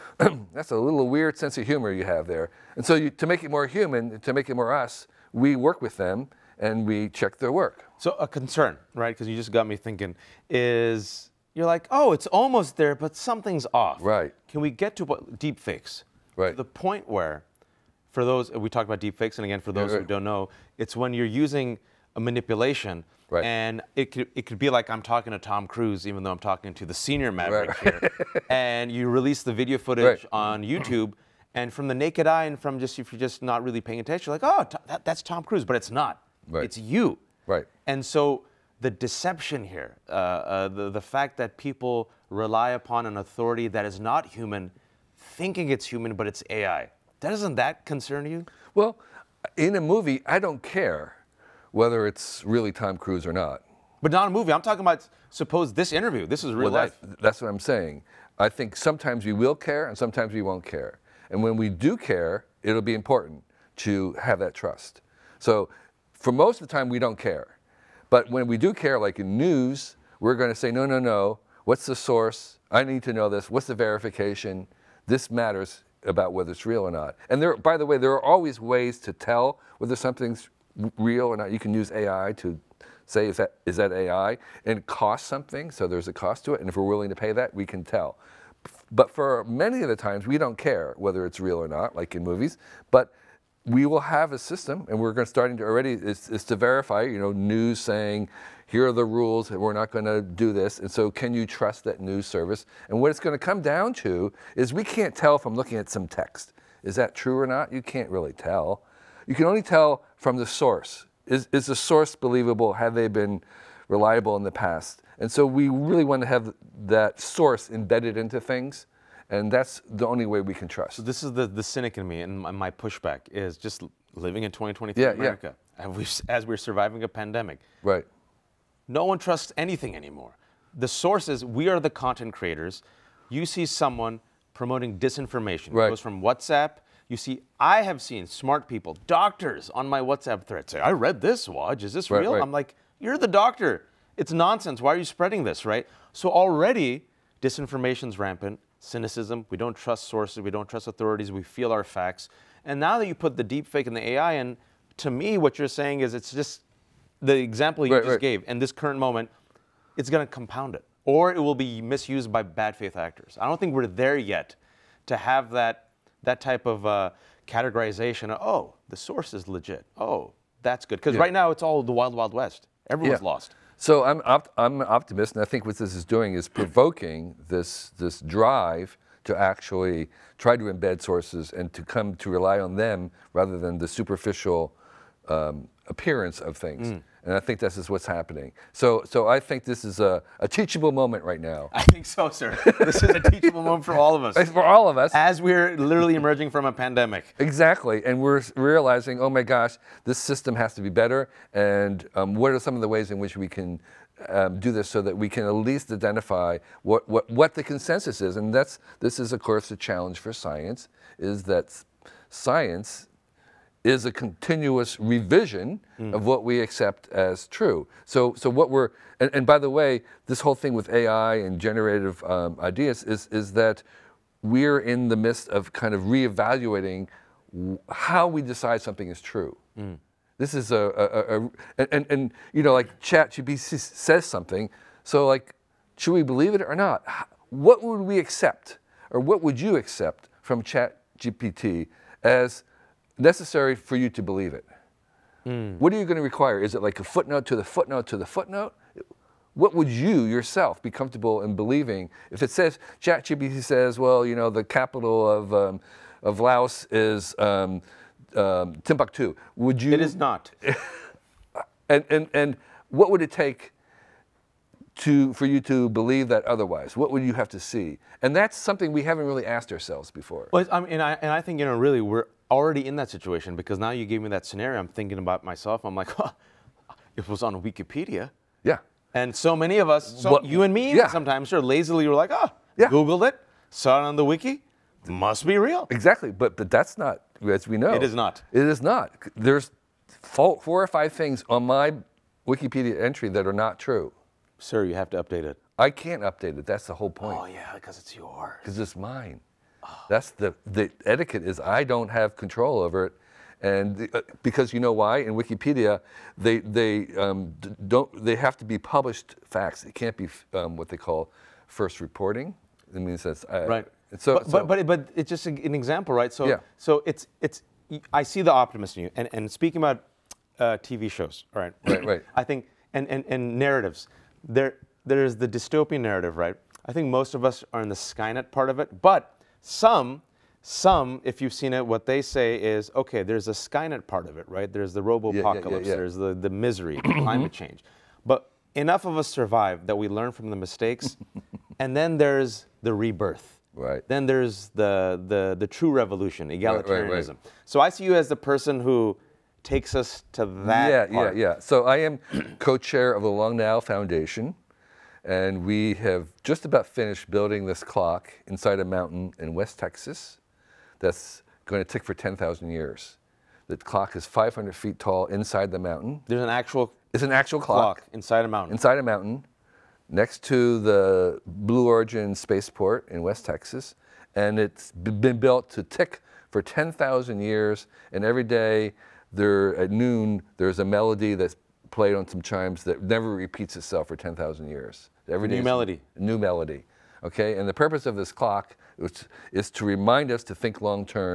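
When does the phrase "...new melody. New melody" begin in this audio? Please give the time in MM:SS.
06:25.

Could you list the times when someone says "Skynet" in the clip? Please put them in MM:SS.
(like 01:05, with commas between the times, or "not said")
05:27, 05:33.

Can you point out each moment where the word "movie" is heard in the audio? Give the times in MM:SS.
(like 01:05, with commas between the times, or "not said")
00:49, 00:54, 01:32.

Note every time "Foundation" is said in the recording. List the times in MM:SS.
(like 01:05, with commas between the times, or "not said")
05:53.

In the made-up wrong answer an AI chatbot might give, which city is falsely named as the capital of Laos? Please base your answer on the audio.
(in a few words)
Timbuktu.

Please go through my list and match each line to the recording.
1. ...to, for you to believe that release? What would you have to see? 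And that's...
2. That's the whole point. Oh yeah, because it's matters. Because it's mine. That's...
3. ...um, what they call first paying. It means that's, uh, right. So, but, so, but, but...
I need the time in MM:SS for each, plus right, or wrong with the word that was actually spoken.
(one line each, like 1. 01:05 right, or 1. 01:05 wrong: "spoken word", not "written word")
1. 04:24 wrong: "otherwise", not "release"
2. 04:56 wrong: "yours", not "matters"
3. 05:10 wrong: "reporting", not "paying".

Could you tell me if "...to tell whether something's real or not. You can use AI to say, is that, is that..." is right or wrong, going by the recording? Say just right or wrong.
right.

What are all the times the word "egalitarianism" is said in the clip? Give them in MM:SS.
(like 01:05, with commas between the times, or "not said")
05:46.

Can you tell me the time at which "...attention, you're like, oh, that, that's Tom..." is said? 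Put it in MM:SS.
00:33.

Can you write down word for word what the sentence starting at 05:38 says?
But enough of us survive that we learn from the mistakes.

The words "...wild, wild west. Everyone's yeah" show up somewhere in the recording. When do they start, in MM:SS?
02:51.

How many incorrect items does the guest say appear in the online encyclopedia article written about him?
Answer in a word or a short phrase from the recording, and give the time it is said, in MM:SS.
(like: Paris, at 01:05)
4 or 5, at 04:50.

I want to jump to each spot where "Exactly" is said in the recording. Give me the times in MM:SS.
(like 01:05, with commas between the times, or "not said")
03:17, 04:45.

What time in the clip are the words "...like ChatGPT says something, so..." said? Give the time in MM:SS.
03:52.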